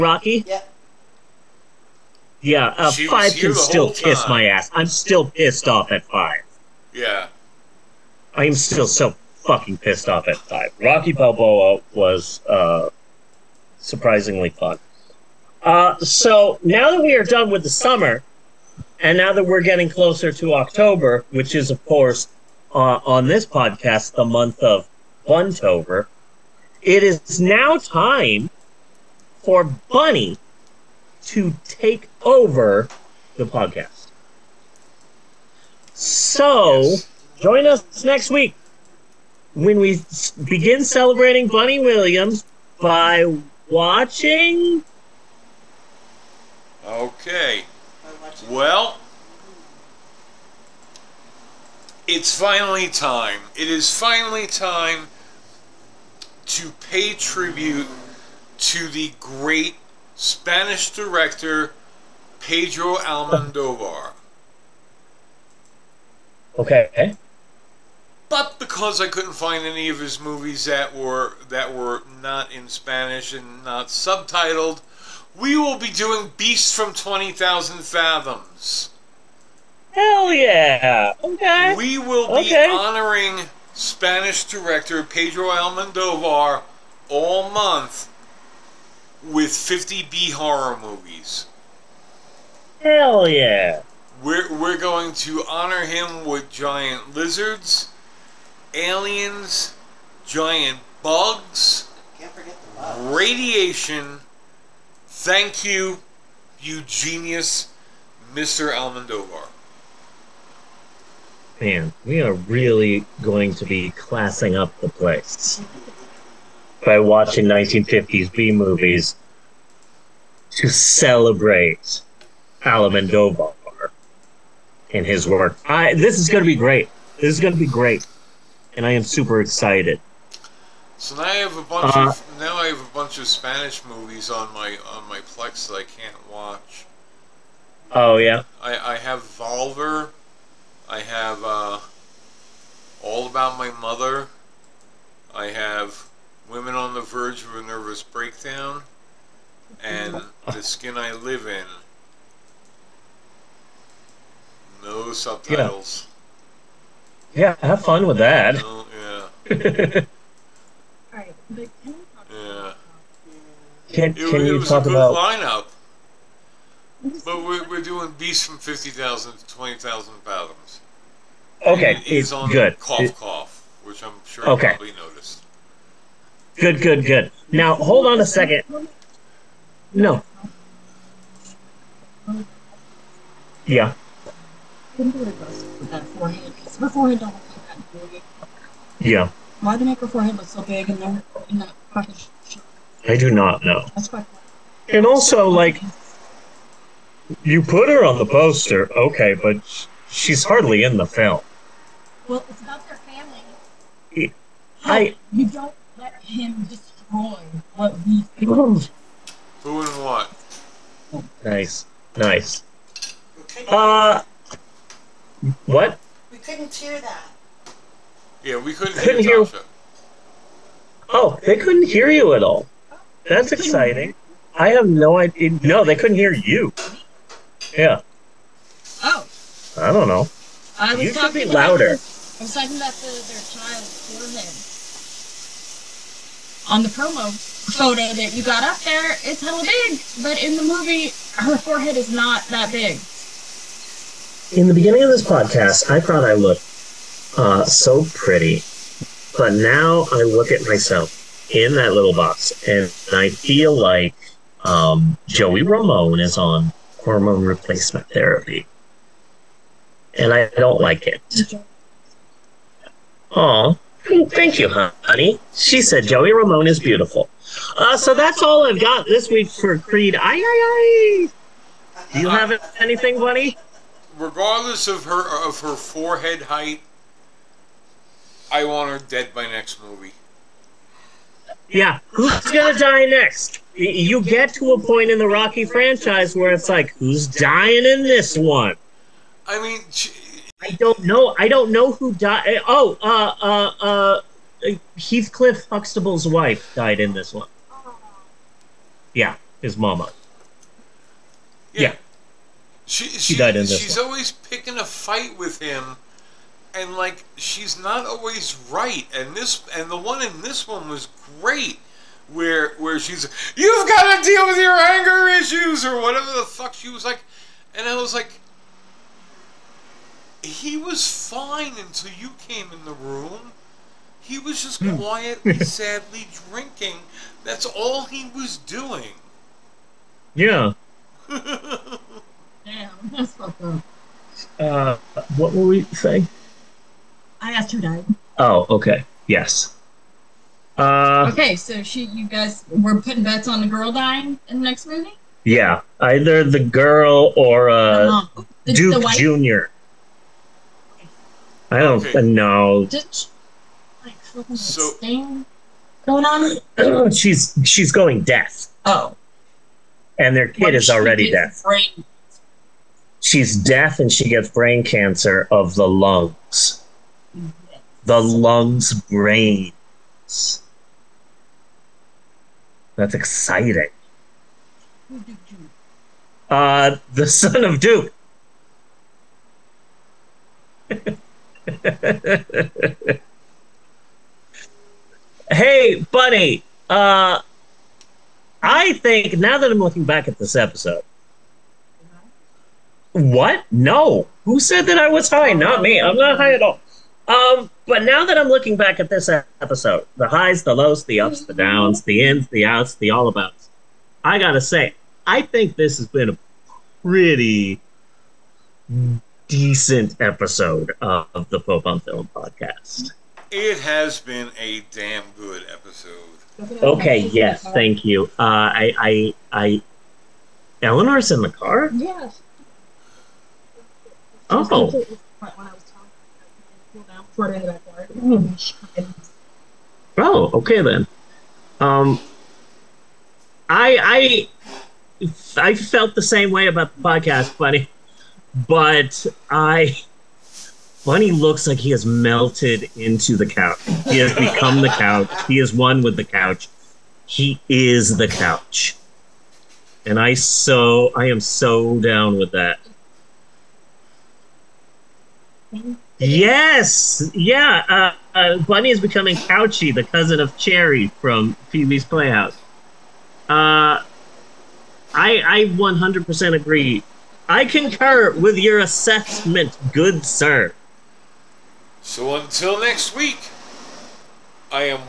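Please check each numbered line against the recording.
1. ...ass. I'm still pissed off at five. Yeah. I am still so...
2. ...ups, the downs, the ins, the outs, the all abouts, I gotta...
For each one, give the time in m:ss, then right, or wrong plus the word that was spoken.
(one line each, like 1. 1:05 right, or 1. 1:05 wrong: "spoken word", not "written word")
1. 0:04 right
2. 6:41 right.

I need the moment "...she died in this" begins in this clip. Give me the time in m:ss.
5:03.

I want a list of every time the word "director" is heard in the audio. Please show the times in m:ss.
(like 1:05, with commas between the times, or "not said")
1:00, 1:24.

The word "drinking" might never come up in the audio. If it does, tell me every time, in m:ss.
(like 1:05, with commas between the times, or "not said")
5:26.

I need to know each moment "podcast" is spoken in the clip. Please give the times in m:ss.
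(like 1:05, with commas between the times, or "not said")
0:23, 0:33, 4:05, 6:52, 7:17.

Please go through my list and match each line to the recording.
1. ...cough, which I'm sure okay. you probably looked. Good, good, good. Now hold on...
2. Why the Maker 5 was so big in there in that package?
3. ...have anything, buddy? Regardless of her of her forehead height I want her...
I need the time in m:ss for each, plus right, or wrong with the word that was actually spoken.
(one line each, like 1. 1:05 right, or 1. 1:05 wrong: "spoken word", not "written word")
1. 2:53 wrong: "noticed", not "looked"
2. 3:09 wrong: "4", not "5"
3. 4:32 right.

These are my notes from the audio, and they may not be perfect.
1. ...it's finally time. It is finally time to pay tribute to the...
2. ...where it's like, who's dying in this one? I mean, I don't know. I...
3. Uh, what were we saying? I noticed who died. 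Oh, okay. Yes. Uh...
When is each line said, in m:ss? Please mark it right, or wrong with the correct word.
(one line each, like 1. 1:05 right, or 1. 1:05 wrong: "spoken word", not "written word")
1. 0:52 right
2. 4:46 right
3. 5:34 wrong: "asked", not "noticed".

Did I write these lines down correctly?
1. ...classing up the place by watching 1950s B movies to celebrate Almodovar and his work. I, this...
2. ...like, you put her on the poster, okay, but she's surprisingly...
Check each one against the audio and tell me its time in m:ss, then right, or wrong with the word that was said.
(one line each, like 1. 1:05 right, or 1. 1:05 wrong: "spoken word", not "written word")
1. 1:53 right
2. 3:15 wrong: "hardly", not "surprisingly".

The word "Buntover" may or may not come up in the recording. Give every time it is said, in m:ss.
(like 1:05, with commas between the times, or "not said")
0:25.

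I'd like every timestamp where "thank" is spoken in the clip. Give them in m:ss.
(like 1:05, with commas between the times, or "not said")
1:45, 4:24, 6:57, 7:35.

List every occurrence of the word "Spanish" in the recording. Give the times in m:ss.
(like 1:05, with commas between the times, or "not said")
1:00, 1:12, 1:23, 2:13.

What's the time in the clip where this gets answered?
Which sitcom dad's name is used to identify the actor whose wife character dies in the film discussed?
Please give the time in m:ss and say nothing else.
4:54.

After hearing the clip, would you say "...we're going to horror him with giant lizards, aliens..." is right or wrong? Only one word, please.
wrong.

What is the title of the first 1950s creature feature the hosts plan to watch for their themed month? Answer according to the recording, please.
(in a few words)
Beast from 20,000 Fathoms.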